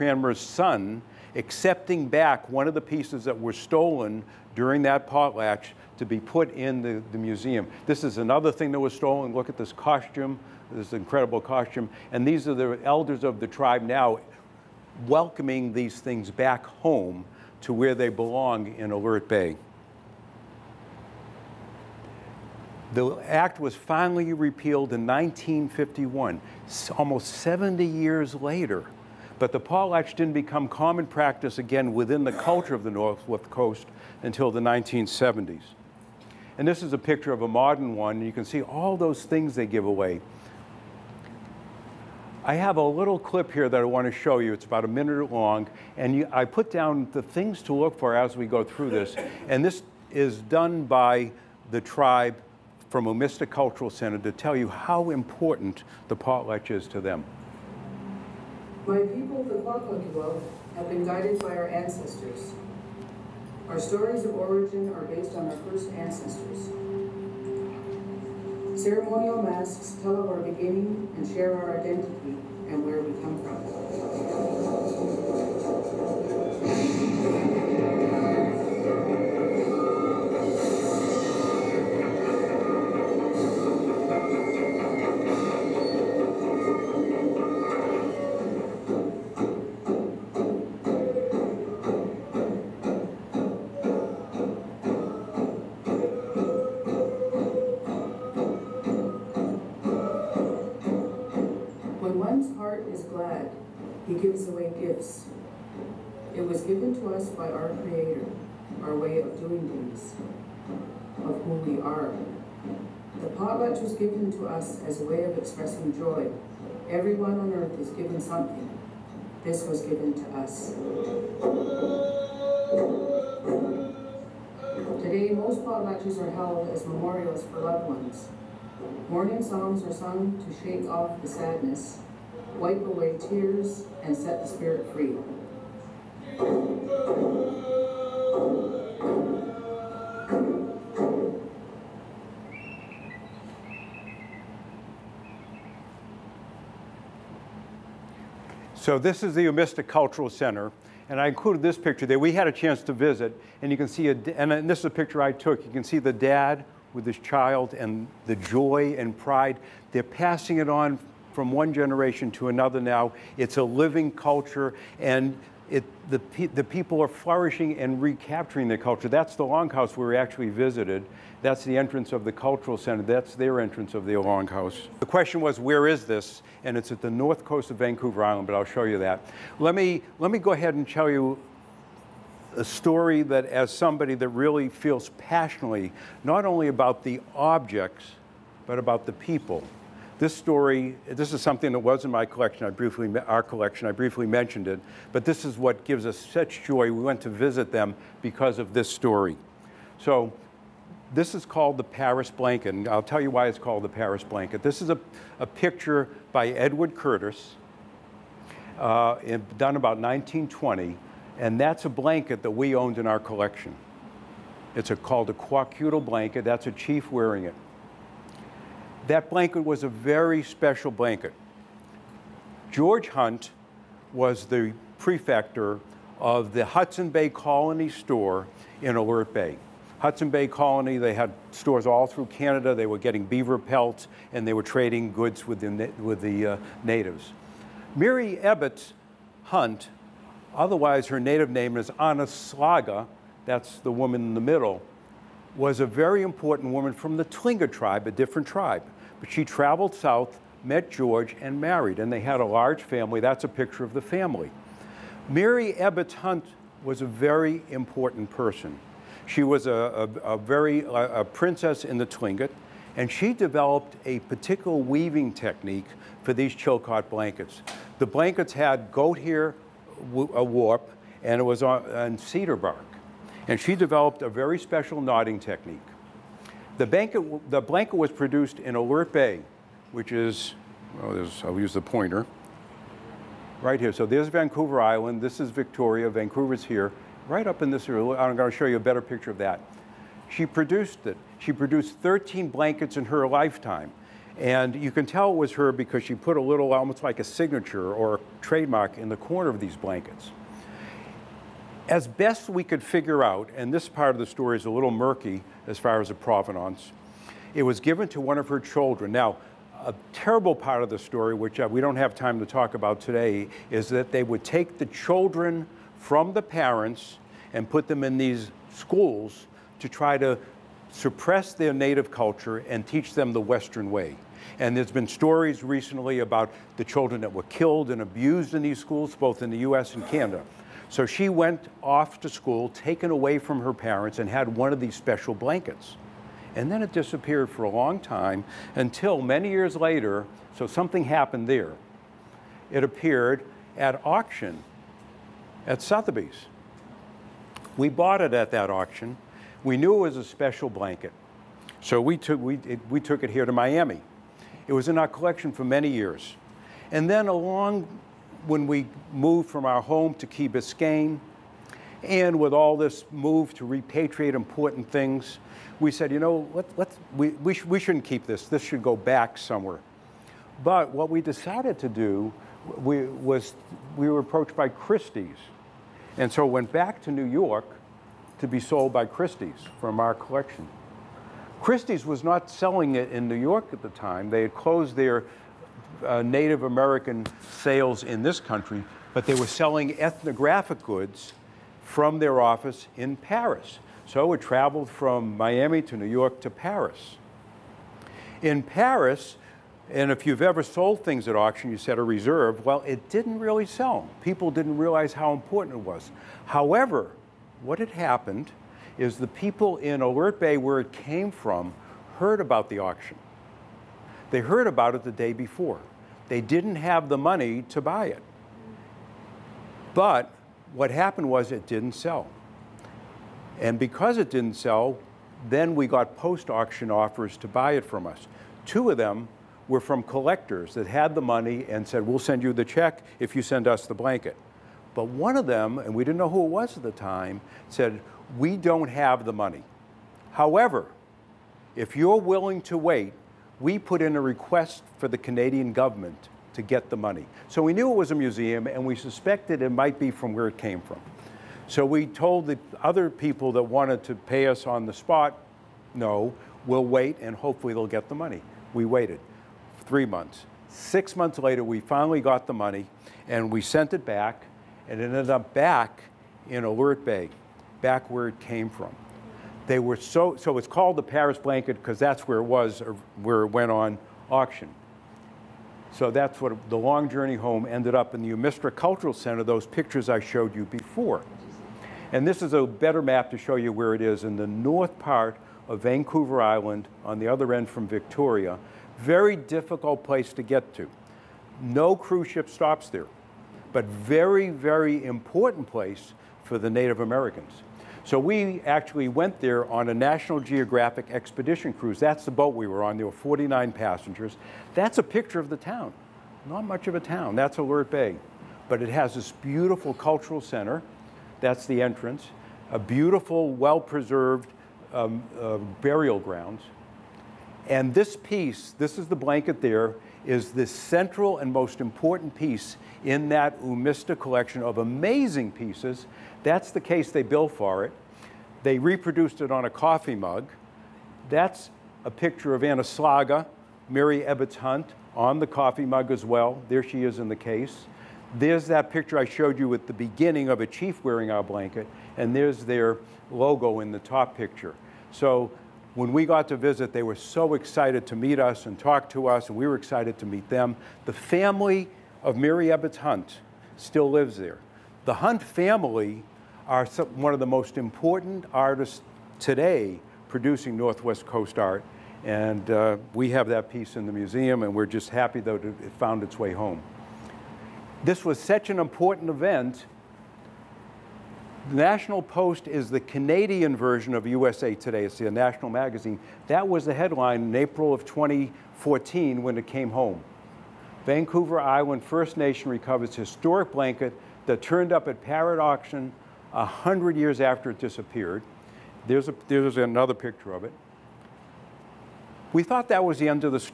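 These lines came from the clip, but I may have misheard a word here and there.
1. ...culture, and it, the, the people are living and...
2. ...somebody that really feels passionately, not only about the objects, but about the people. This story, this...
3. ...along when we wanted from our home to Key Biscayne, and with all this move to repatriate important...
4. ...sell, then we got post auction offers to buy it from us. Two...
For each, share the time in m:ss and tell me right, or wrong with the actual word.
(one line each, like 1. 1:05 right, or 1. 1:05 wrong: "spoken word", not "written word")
1. 2:44 wrong: "flourishing", not "living"
2. 3:03 right
3. 5:57 wrong: "moved", not "wanted"
4. 7:04 right.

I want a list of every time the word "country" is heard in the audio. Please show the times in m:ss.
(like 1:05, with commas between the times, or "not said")
6:28.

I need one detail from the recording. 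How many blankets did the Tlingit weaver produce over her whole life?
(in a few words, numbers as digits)
13.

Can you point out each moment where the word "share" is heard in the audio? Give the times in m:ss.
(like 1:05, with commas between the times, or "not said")
1:11.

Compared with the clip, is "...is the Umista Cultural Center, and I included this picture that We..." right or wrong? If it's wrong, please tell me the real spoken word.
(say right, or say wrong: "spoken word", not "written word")
right.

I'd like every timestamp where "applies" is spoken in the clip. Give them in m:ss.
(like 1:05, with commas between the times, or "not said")
not said.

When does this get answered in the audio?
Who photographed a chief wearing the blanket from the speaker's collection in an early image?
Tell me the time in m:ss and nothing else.
3:26.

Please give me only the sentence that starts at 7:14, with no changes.
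But one of them, and we didn't know who it was at the time, said, We don't have the money.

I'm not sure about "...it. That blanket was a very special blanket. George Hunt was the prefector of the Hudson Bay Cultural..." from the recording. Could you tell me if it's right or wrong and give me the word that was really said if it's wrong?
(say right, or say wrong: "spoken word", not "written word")
wrong: "Colony", not "Cultural".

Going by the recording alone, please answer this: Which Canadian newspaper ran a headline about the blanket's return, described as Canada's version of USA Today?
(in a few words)
National Post.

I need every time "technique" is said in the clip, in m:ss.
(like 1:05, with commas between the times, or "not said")
4:25, 4:35.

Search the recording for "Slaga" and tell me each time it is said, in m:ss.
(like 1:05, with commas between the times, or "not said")
4:02, 8:52.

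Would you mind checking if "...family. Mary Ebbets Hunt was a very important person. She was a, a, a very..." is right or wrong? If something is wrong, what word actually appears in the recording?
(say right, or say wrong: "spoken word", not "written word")
right.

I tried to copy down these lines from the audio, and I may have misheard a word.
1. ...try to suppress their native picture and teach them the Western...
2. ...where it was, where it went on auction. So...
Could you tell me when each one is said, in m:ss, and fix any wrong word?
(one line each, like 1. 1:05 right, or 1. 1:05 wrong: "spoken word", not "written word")
1. 5:19 wrong: "culture", not "picture"
2. 7:52 right.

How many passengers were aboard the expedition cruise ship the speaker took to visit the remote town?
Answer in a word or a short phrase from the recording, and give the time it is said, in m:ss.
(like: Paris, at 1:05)
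49, at 8:23.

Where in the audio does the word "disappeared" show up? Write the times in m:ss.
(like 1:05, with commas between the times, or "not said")
5:36, 9:47.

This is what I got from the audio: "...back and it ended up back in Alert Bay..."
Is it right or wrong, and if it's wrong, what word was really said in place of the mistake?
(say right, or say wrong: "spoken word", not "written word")
right.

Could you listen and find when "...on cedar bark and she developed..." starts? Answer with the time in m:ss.
4:31.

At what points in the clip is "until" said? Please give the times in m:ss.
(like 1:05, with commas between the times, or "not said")
0:34, 5:38.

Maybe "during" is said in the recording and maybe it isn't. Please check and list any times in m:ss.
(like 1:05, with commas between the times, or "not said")
0:04.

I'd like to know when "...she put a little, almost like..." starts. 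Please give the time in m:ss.
4:56.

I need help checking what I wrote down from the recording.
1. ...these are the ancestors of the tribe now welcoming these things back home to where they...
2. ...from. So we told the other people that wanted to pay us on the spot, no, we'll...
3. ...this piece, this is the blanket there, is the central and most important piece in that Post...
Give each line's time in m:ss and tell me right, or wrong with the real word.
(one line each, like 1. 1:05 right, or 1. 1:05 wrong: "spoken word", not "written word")
1. 0:12 wrong: "elders", not "ancestors"
2. 7:30 right
3. 8:37 wrong: "Umista", not "Post".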